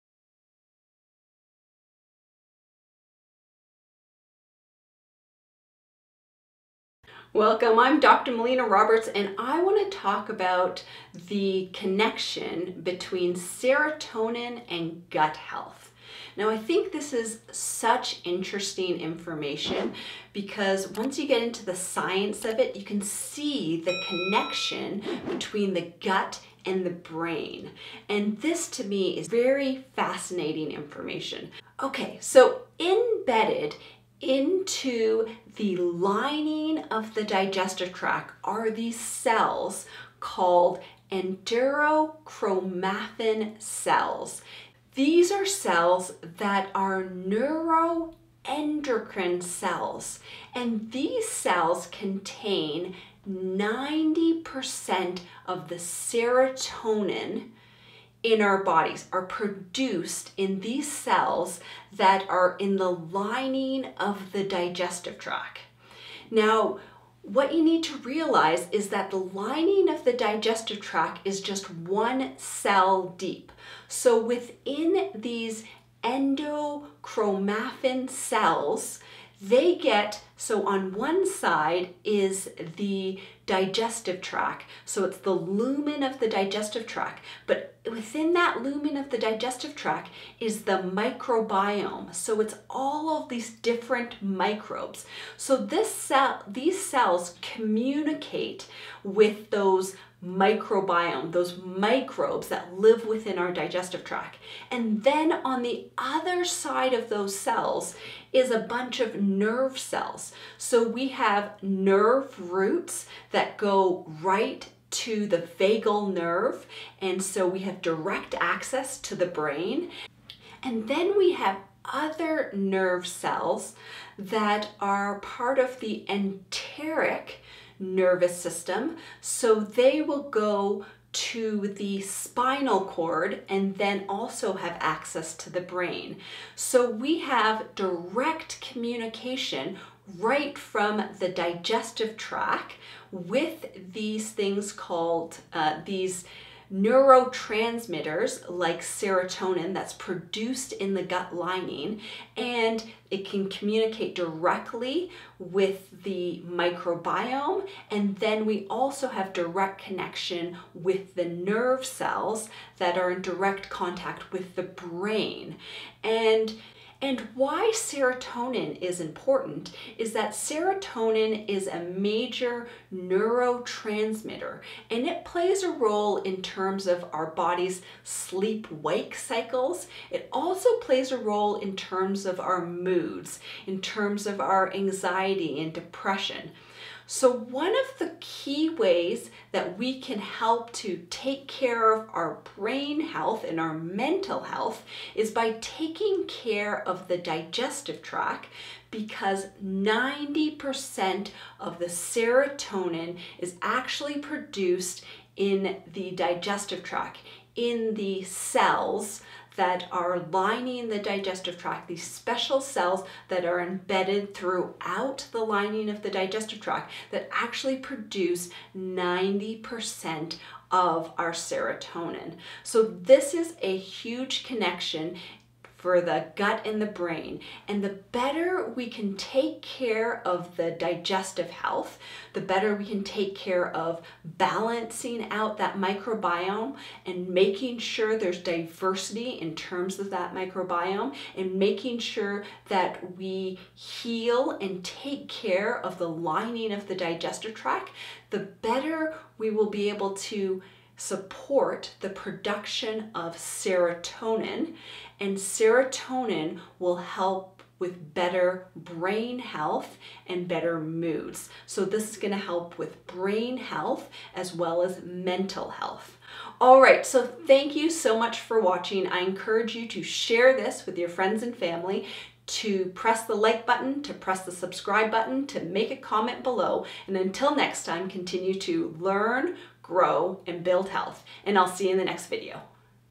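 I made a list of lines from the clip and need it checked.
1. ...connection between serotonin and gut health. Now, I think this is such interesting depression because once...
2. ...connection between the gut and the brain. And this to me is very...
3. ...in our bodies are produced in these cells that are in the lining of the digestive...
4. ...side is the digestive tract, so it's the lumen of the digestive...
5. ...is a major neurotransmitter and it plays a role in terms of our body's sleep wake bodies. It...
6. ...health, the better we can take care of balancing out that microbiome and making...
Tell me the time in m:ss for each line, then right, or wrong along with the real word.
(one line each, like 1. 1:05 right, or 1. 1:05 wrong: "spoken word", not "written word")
1. 0:11 wrong: "information", not "depression"
2. 0:24 right
3. 0:58 right
4. 1:21 right
5. 2:51 wrong: "cycles", not "bodies"
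6. 3:51 right.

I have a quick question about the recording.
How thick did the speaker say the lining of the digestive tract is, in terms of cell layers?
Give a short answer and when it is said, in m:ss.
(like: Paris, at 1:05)
One cell deep, at 1:11.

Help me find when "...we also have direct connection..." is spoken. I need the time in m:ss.
2:38.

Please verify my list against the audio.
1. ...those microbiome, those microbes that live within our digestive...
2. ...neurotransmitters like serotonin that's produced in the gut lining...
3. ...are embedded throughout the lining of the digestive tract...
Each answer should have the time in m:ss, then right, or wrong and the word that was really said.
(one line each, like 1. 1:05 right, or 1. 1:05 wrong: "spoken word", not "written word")
1. 1:39 right
2. 2:26 right
3. 3:33 right.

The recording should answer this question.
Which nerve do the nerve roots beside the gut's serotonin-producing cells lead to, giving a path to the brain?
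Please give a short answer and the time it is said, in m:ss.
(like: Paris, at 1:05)
Vagal nerve, at 1:55.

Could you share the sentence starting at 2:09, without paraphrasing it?
So they will go to the spinal cord and then also have access to the brain.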